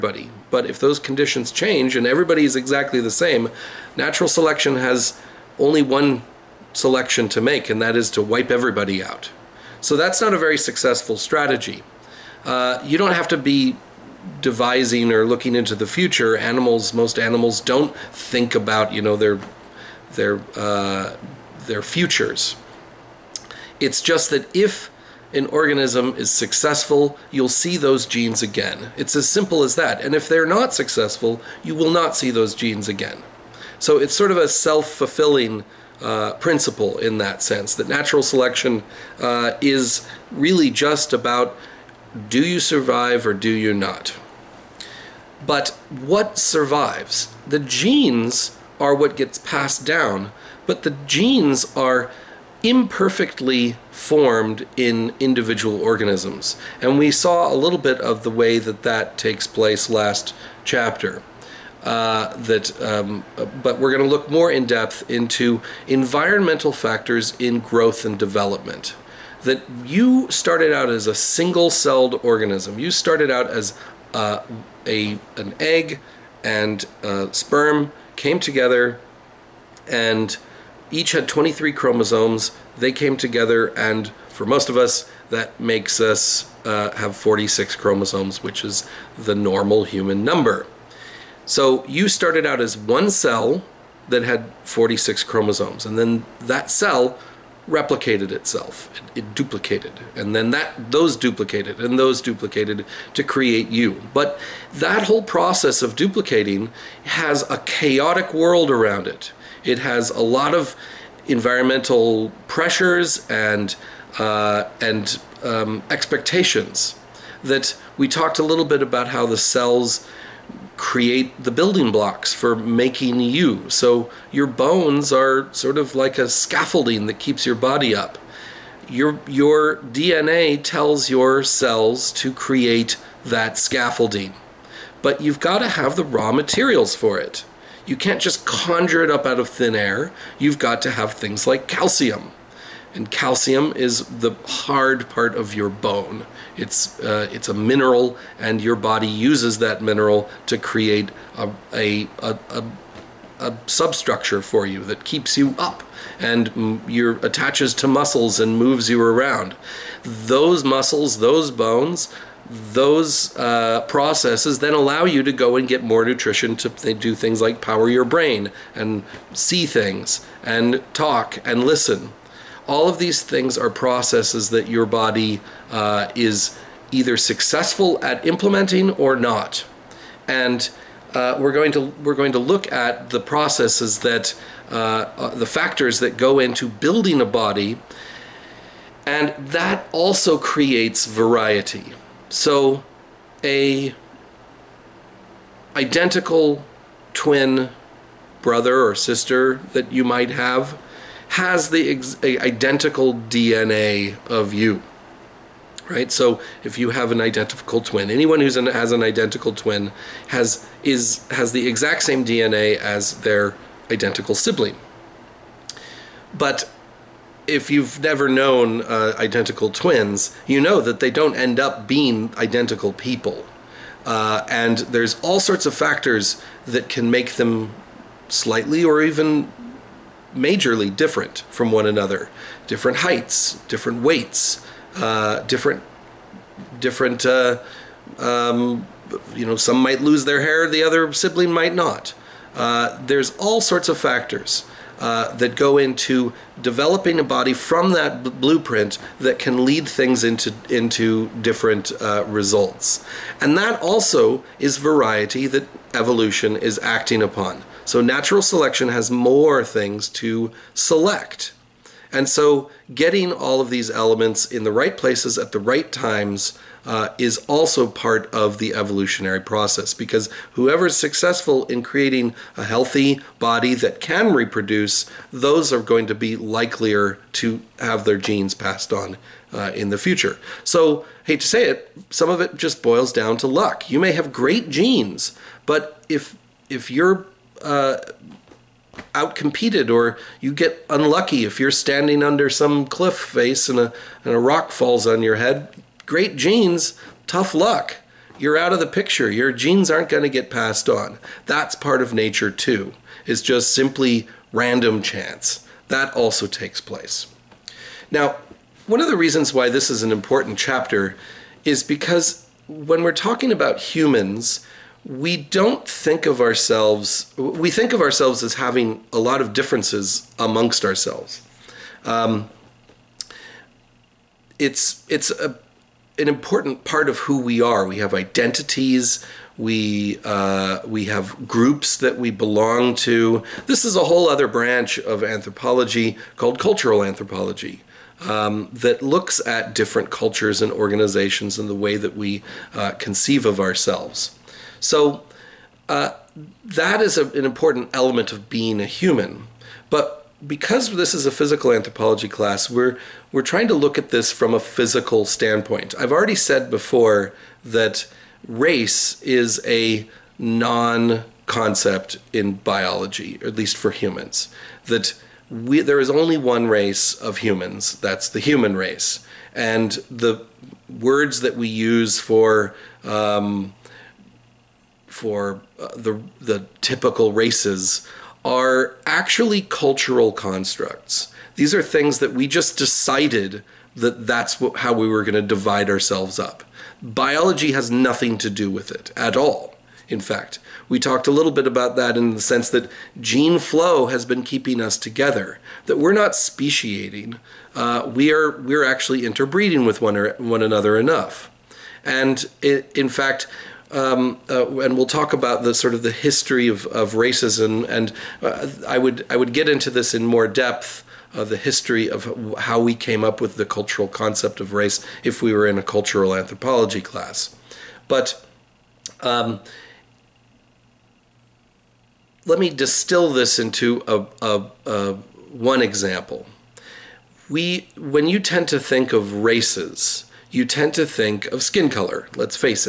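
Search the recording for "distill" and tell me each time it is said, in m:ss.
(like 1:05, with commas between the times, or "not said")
7:02.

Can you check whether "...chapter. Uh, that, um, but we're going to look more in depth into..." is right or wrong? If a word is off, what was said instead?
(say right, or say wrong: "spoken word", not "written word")
right.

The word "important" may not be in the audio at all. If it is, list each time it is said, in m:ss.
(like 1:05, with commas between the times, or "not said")
5:10, 5:26, 5:47.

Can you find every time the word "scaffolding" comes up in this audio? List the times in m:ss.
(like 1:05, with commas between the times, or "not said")
2:06, 2:13.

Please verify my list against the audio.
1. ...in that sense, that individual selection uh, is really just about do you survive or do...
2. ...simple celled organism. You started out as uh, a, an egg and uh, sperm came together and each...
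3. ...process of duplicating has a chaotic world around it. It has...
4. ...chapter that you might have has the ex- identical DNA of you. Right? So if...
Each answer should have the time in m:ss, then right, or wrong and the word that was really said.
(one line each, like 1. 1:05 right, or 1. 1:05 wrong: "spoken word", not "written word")
1. 0:36 wrong: "natural", not "individual"
2. 1:11 wrong: "single", not "simple"
3. 1:45 right
4. 3:18 wrong: "sister", not "chapter".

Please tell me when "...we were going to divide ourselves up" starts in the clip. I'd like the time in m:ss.
6:24.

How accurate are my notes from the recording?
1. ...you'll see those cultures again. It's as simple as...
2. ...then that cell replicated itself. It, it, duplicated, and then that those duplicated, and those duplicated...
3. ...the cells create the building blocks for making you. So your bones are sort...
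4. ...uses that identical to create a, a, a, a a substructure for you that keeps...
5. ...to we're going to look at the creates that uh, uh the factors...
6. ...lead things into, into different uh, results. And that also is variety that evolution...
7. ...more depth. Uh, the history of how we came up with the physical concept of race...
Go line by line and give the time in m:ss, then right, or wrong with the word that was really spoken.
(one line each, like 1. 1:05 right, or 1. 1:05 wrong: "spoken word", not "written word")
1. 0:27 wrong: "genes", not "cultures"
2. 1:35 right
3. 1:59 right
4. 2:29 wrong: "mineral", not "identical"
5. 3:01 wrong: "processes", not "creates"
6. 4:09 right
7. 6:50 wrong: "cultural", not "physical".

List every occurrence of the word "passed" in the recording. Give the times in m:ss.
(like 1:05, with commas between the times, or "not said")
0:49, 4:38, 5:00.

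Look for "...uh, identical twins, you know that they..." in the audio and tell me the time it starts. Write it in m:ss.
3:38.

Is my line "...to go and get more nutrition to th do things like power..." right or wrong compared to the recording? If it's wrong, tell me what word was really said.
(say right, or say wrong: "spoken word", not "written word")
right.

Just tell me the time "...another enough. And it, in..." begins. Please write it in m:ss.
6:40.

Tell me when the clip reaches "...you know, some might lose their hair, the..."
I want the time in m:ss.
3:59.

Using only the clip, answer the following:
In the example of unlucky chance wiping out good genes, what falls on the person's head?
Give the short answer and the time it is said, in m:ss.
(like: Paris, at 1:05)
a rock, at 4:54.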